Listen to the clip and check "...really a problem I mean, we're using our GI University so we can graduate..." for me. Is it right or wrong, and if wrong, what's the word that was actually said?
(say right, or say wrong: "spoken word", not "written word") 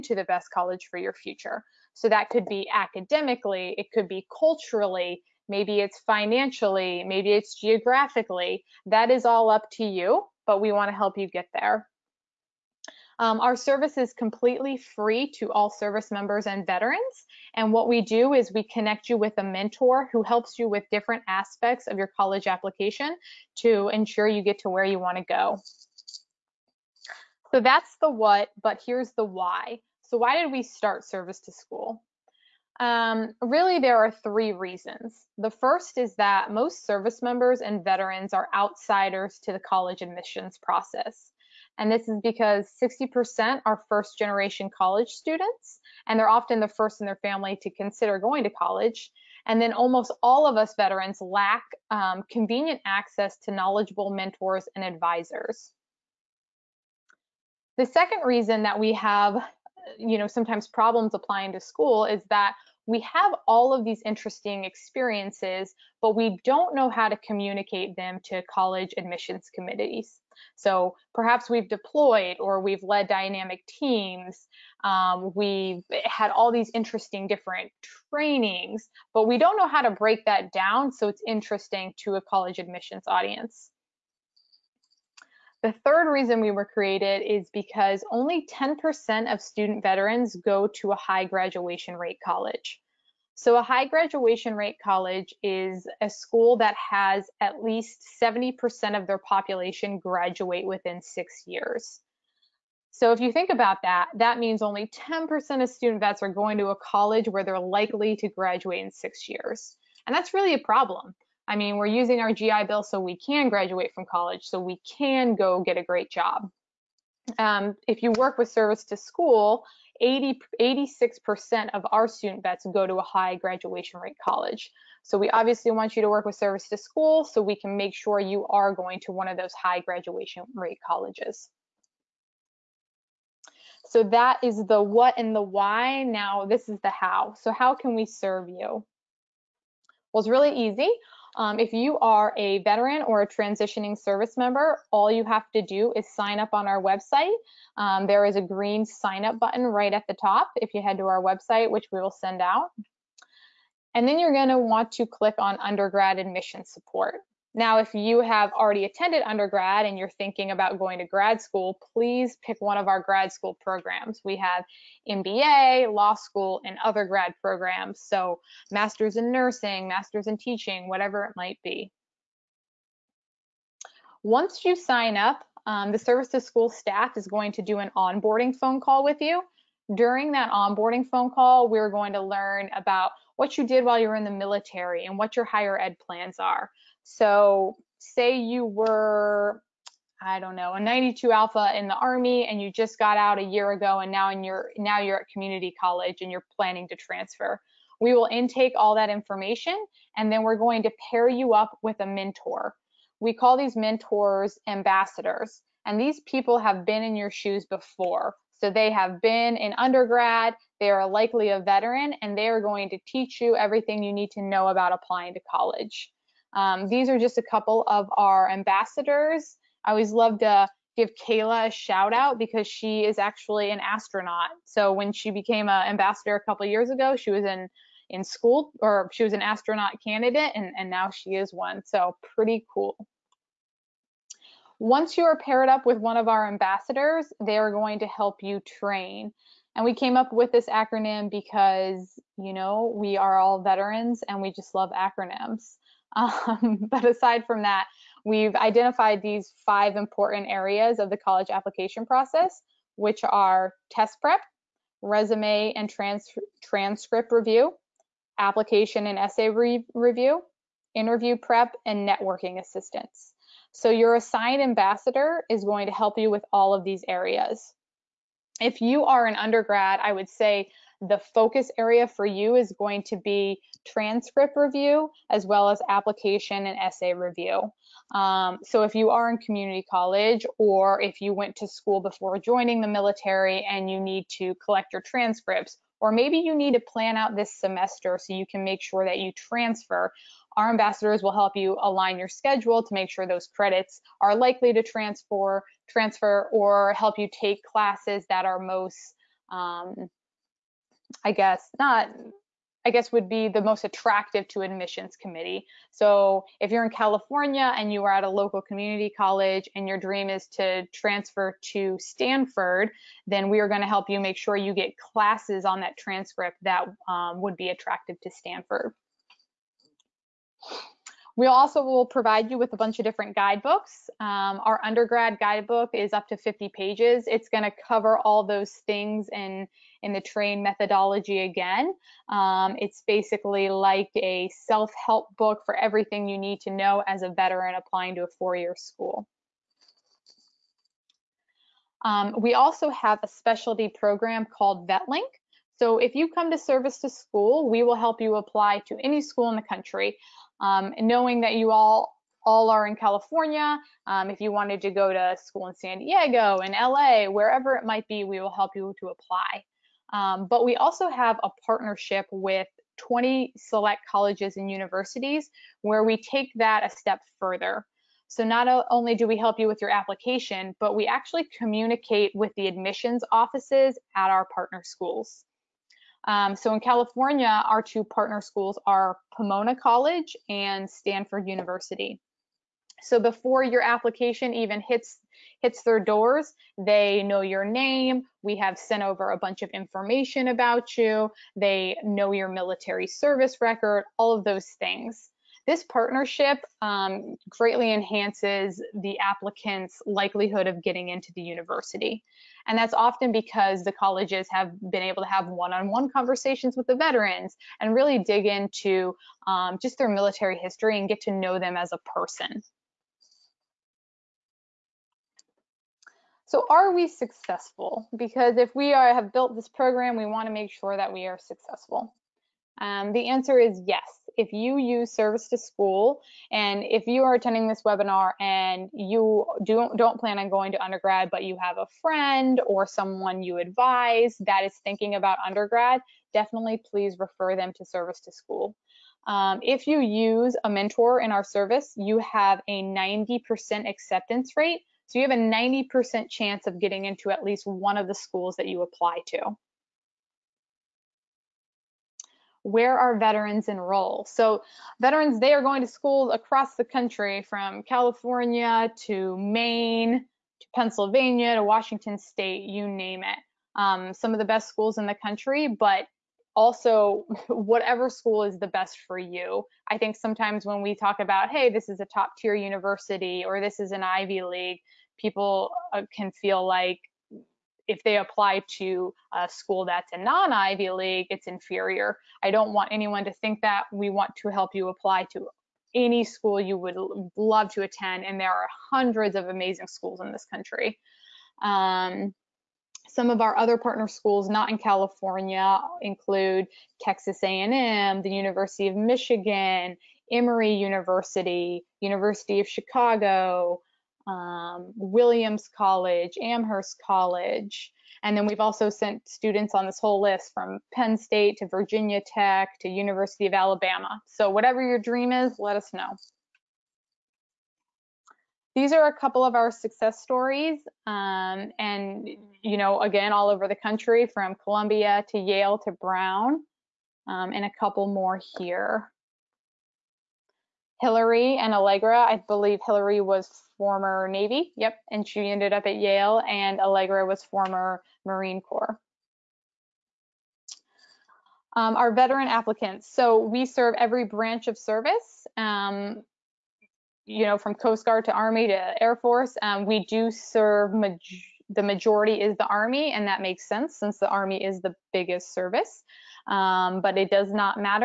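wrong: "Bill", not "University".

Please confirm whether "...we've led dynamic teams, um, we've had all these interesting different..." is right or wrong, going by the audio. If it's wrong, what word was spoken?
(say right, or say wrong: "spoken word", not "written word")
right.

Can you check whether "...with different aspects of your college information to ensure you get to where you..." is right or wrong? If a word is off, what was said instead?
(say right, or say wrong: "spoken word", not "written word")
wrong: "application", not "information".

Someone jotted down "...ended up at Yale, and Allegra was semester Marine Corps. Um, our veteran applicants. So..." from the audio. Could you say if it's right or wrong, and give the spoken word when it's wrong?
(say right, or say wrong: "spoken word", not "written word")
wrong: "former", not "semester".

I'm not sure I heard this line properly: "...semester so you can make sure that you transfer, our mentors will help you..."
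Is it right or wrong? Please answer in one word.
wrong.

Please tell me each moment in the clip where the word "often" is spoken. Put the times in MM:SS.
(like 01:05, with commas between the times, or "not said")
00:46, 06:42.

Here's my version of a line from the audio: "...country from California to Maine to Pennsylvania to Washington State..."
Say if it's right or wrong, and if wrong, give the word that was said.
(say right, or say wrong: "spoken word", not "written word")
right.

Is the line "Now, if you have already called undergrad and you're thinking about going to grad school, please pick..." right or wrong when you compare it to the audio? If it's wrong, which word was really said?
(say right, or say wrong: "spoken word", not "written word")
wrong: "attended", not "called".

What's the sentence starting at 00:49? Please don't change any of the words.
And then almost all of us veterans lack um, convenient access to knowledgeable mentors and advisors.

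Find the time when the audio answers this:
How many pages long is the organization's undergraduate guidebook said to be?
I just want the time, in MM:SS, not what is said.
05:26.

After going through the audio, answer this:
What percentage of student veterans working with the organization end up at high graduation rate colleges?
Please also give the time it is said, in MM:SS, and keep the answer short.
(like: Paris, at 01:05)
86%, at 02:00.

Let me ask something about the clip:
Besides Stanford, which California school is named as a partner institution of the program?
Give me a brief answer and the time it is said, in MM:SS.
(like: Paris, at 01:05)
Pomona College, at 06:19.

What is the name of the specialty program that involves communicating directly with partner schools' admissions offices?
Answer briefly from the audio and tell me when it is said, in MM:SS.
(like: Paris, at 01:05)
VetLink, at 05:44.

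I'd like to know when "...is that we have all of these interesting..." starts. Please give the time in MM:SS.
01:02.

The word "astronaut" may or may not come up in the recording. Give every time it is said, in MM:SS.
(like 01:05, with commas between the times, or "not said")
03:43, 03:49.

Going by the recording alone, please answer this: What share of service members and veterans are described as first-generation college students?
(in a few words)
60%.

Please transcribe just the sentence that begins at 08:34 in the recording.
So whatever your dream is, let us know these are a couple of our success stories.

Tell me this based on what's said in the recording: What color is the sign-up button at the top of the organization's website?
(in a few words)
green.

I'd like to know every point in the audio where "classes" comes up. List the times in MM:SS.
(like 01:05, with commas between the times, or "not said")
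04:57, 05:14.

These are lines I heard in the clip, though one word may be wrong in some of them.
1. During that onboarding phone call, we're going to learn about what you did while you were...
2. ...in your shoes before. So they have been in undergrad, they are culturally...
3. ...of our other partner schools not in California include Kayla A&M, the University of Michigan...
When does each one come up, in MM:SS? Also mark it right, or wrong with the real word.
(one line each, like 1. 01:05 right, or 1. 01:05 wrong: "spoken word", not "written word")
1. 02:59 right
2. 03:27 wrong: "likely", not "culturally"
3. 08:13 wrong: "Texas", not "Kayla".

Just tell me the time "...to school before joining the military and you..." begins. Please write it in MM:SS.
04:41.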